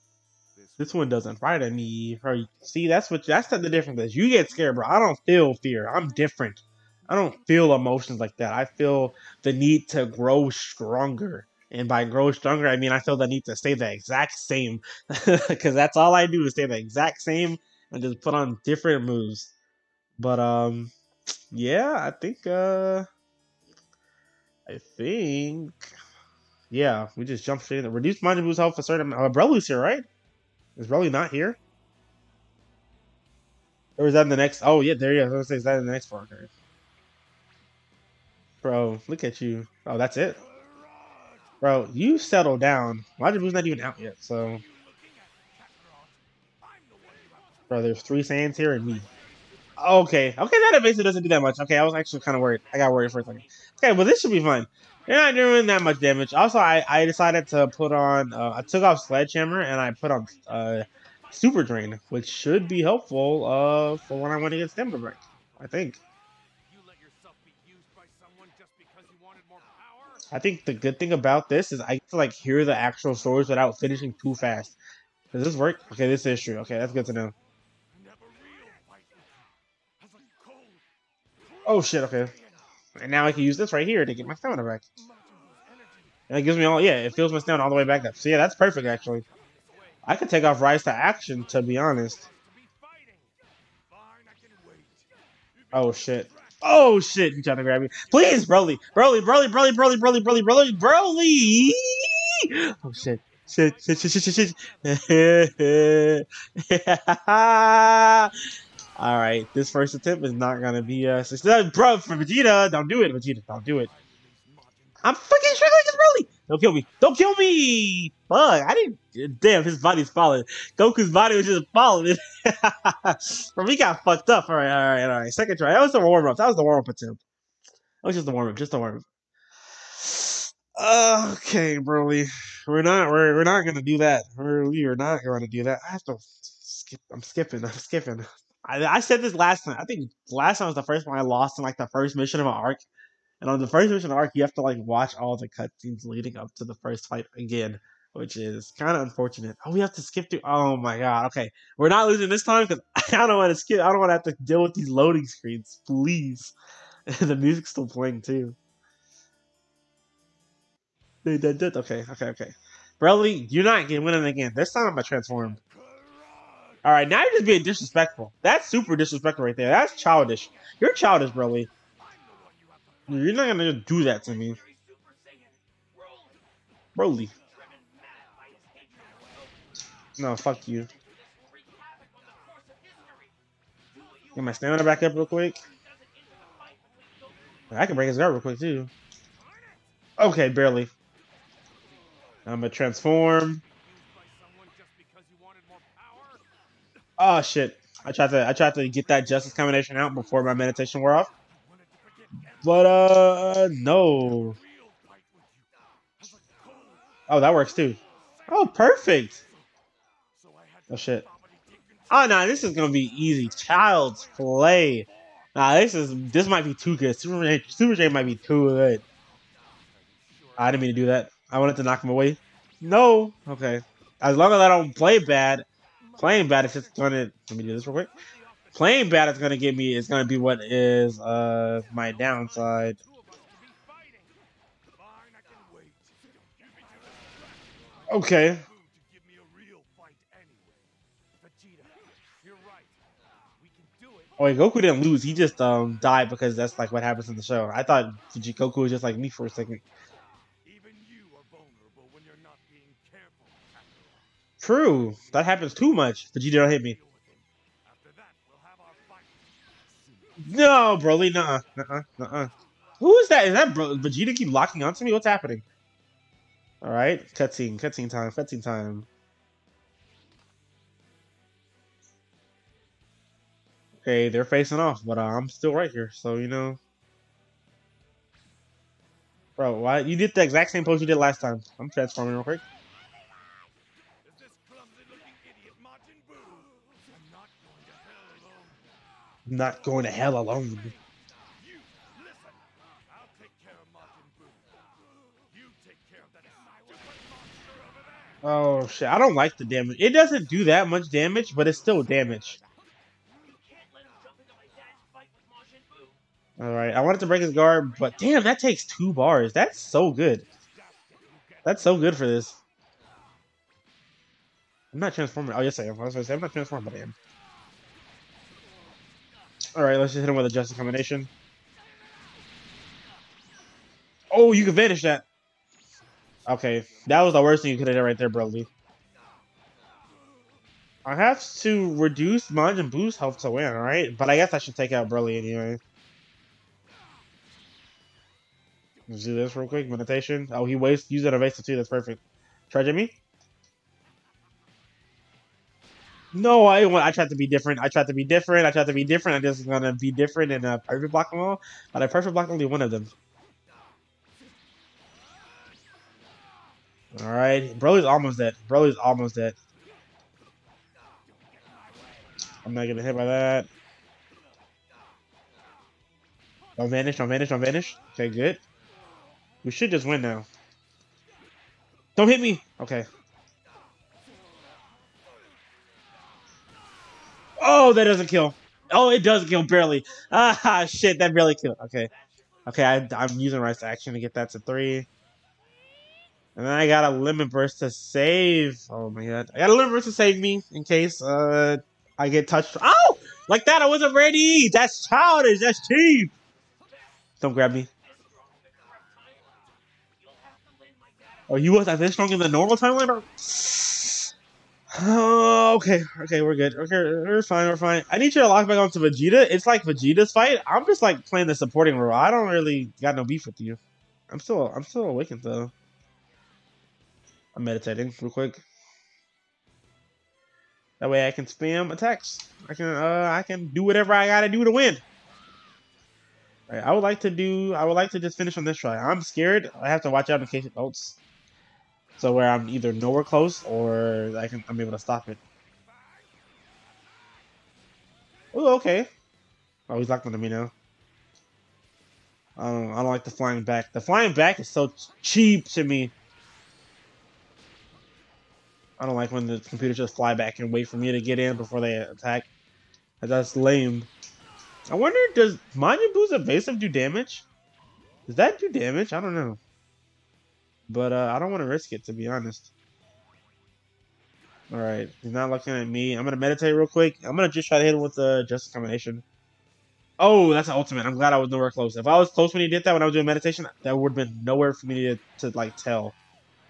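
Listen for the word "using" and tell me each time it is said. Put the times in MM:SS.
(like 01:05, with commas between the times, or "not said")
06:23.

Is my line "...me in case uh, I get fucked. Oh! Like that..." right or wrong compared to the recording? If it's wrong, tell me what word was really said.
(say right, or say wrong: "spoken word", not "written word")
wrong: "touched", not "fucked".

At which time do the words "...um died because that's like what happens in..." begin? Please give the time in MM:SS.
04:05.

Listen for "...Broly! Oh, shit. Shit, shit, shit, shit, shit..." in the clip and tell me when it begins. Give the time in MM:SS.
01:40.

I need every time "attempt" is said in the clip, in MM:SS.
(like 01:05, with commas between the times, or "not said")
01:49, 02:06.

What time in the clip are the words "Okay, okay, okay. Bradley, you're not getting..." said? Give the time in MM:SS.
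02:41.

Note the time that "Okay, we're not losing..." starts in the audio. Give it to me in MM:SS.
02:31.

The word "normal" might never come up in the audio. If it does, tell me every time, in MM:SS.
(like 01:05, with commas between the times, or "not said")
06:42.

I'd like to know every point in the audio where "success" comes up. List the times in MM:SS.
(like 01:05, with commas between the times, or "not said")
01:51.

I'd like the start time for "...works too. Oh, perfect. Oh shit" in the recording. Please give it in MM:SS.
03:27.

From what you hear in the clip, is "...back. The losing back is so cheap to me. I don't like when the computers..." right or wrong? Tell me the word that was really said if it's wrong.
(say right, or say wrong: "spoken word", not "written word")
wrong: "flying", not "losing".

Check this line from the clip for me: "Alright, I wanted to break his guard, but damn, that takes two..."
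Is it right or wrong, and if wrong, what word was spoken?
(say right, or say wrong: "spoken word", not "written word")
right.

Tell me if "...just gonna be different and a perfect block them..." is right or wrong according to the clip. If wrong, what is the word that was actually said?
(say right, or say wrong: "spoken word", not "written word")
right.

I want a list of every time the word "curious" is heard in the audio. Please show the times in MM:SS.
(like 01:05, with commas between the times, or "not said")
not said.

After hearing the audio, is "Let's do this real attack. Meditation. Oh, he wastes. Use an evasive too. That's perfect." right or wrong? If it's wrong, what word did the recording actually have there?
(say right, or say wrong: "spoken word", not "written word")
wrong: "quick", not "attack".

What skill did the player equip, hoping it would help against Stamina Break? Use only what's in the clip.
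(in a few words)
Super Drain.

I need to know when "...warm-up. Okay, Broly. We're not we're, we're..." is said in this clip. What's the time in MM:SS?
02:08.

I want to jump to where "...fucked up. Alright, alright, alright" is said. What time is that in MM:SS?
02:04.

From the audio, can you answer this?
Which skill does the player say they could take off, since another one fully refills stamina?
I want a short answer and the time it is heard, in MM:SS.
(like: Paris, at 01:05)
Rise to Action, at 01:30.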